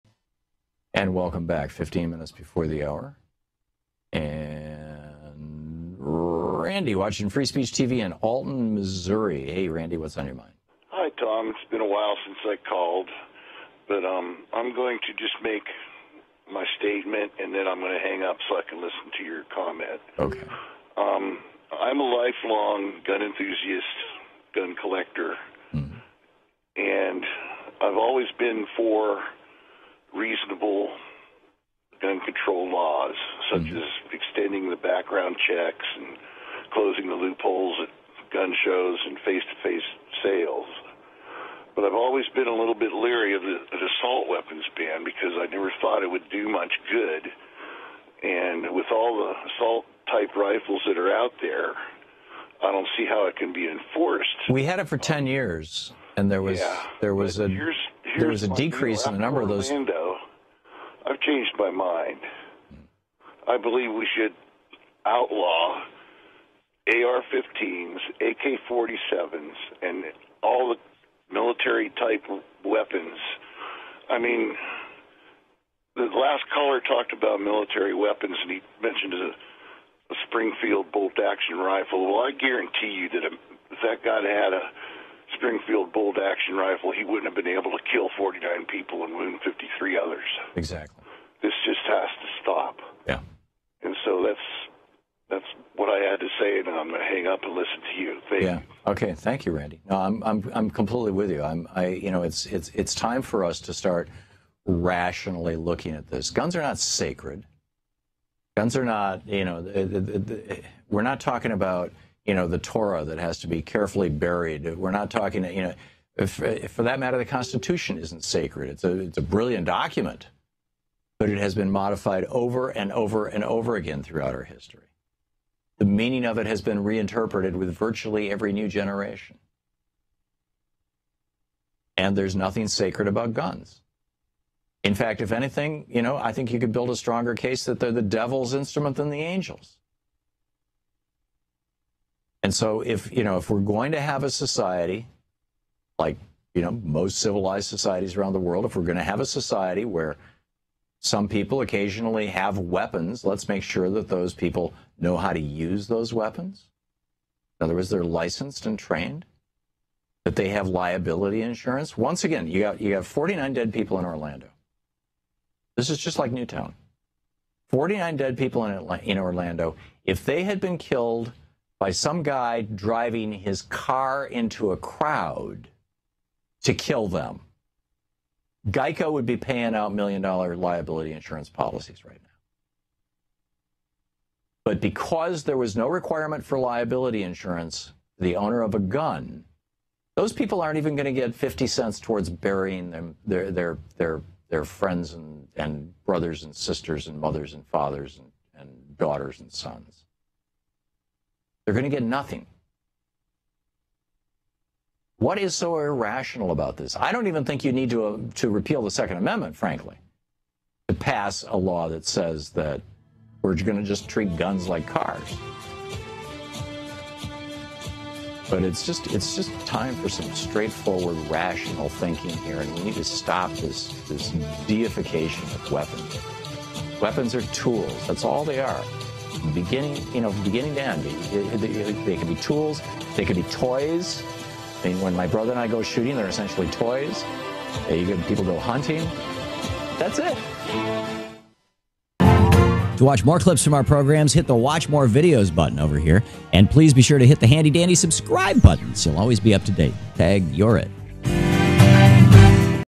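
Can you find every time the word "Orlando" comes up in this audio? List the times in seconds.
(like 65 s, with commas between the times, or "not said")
59 s, 164 s, 169 s.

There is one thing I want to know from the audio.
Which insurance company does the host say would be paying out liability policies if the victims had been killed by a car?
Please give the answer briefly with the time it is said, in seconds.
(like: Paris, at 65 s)
Geico, at 178 s.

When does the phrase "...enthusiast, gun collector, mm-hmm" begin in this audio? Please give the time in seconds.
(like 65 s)
23 s.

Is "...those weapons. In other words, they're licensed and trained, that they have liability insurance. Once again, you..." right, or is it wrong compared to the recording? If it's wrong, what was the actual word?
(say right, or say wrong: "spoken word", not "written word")
right.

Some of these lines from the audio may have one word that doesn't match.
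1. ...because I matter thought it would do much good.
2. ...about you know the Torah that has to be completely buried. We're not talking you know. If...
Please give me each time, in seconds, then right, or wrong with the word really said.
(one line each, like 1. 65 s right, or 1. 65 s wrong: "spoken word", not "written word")
1. 45 s wrong: "never", not "matter"
2. 111 s wrong: "carefully", not "completely".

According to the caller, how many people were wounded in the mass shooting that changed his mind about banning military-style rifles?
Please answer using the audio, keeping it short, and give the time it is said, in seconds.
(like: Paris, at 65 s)
53, at 89 s.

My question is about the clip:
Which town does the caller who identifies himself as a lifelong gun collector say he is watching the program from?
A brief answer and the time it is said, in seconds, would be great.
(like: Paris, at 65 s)
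Alton, Missouri, at 8 s.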